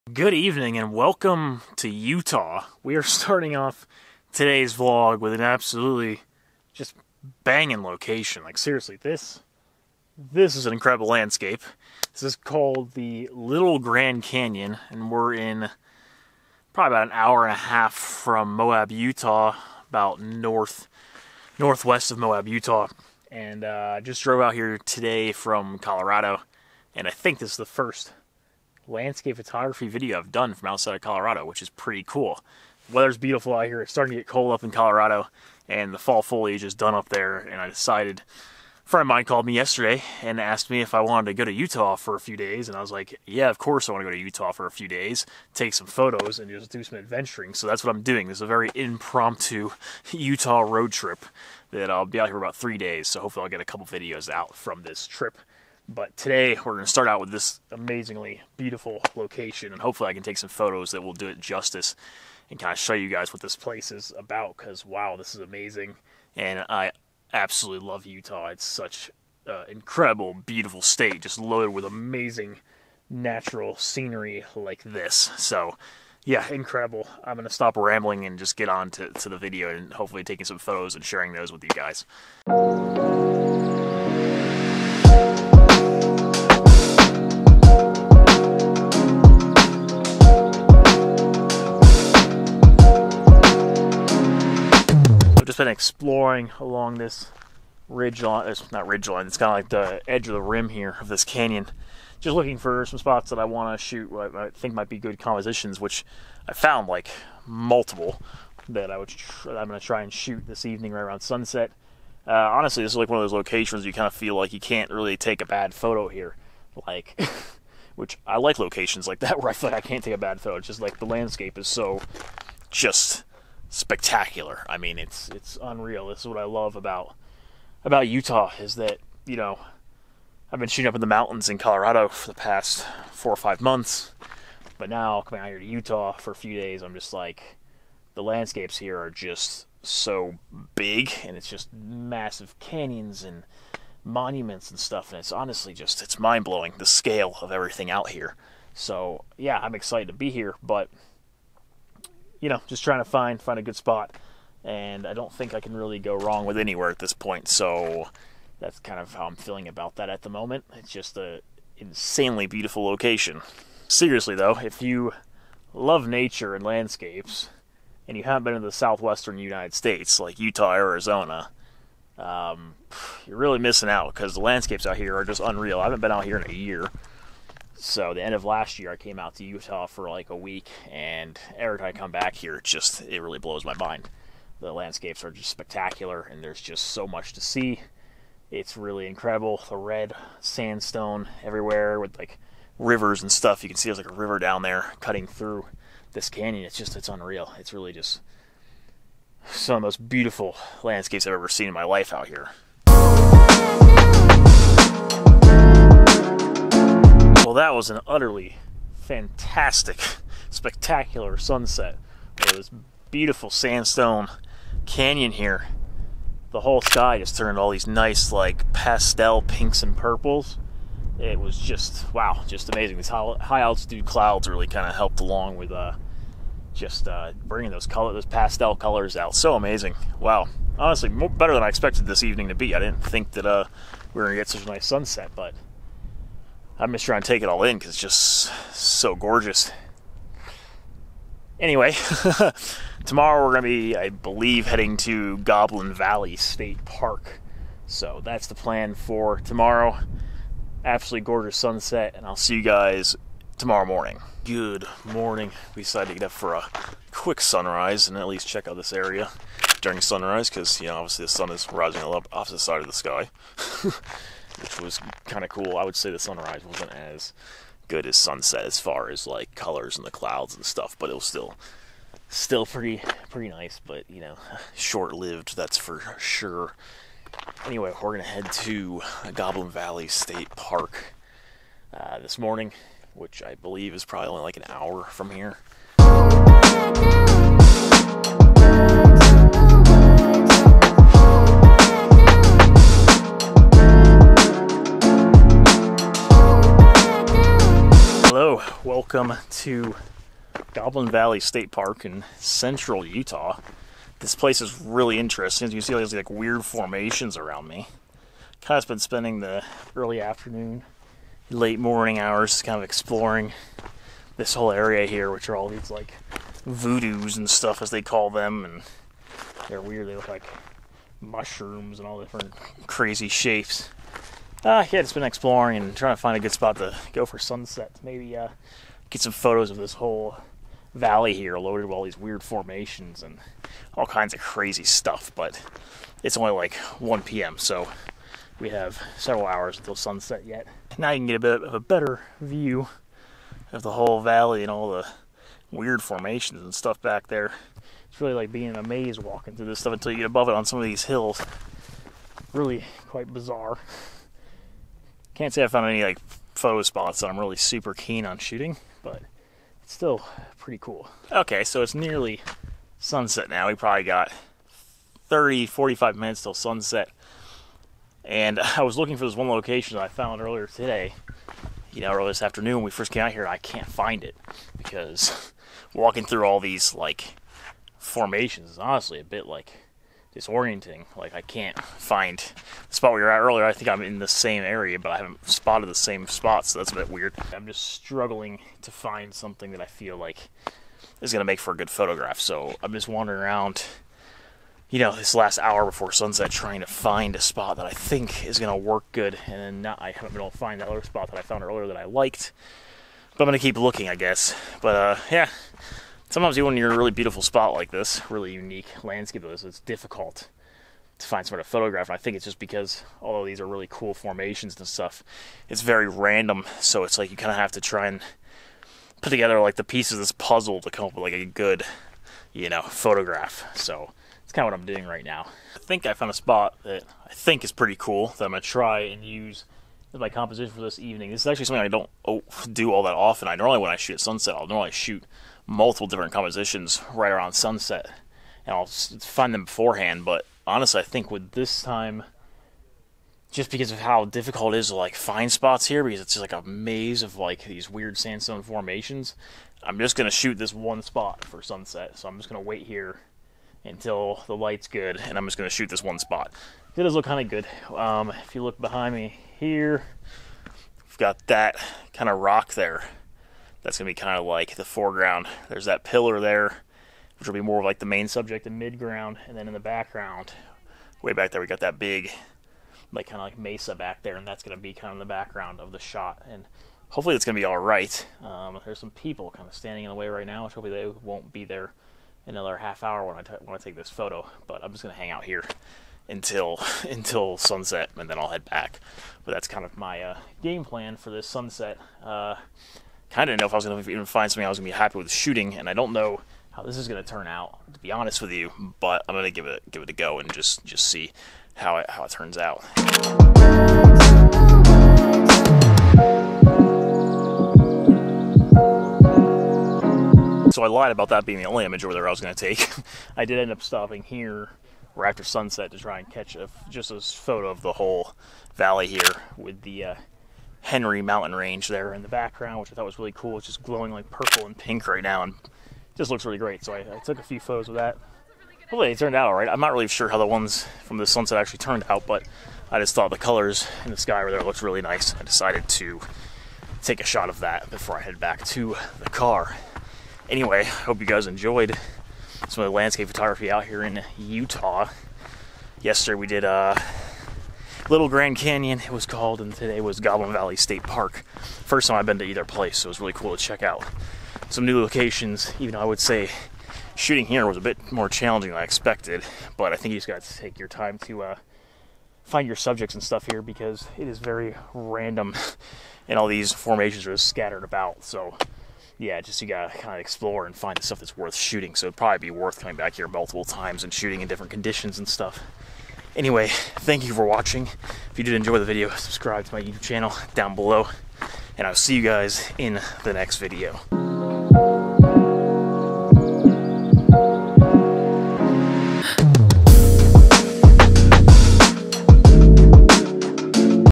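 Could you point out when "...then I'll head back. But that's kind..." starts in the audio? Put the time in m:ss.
8:08.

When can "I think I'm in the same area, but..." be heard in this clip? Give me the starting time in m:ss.
6:23.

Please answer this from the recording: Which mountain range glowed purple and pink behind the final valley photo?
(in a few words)
Henry mountain range.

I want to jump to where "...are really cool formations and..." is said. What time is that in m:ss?
6:53.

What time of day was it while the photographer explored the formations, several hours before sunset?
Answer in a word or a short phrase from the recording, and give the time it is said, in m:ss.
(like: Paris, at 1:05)
1 p.m., at 5:36.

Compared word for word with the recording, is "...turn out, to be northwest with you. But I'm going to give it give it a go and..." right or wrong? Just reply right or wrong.
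wrong.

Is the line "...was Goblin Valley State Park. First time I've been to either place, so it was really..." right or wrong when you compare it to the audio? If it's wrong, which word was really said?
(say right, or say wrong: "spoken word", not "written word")
right.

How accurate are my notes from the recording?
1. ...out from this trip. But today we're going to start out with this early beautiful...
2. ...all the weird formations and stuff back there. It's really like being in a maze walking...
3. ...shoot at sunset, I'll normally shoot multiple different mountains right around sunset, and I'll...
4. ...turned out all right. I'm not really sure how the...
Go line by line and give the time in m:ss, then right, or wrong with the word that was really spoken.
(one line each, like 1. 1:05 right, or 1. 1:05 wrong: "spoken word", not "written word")
1. 0:54 wrong: "amazingly", not "early"
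2. 5:44 right
3. 7:13 wrong: "compositions", not "mountains"
4. 8:49 right.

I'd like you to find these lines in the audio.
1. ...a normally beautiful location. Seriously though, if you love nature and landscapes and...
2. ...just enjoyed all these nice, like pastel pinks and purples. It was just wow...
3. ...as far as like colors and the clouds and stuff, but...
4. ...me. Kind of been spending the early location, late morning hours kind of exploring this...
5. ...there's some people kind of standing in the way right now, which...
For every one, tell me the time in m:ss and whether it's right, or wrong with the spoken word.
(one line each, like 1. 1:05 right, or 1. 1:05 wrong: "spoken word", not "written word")
1. 2:41 wrong: "insanely", not "normally"
2. 3:37 wrong: "turned", not "enjoyed"
3. 4:28 right
4. 5:07 wrong: "afternoon", not "location"
5. 7:58 right.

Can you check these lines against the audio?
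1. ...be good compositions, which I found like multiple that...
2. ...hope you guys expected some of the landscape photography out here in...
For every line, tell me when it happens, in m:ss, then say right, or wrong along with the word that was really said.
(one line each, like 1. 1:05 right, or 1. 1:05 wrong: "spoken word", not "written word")
1. 1:44 right
2. 9:00 wrong: "enjoyed", not "expected".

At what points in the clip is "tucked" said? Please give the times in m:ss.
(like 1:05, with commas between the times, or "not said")
not said.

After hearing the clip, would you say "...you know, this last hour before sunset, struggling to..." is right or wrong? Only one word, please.
wrong.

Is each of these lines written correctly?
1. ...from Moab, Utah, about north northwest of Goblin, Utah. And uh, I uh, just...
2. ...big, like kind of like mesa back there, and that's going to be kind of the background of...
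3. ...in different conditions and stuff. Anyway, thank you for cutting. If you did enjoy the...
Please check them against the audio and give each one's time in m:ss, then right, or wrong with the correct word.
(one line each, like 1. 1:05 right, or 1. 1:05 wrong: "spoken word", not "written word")
1. 0:17 wrong: "Moab", not "Goblin"
2. 7:51 right
3. 9:34 wrong: "watching", not "cutting".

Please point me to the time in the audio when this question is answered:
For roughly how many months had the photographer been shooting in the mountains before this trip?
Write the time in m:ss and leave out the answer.
2:13.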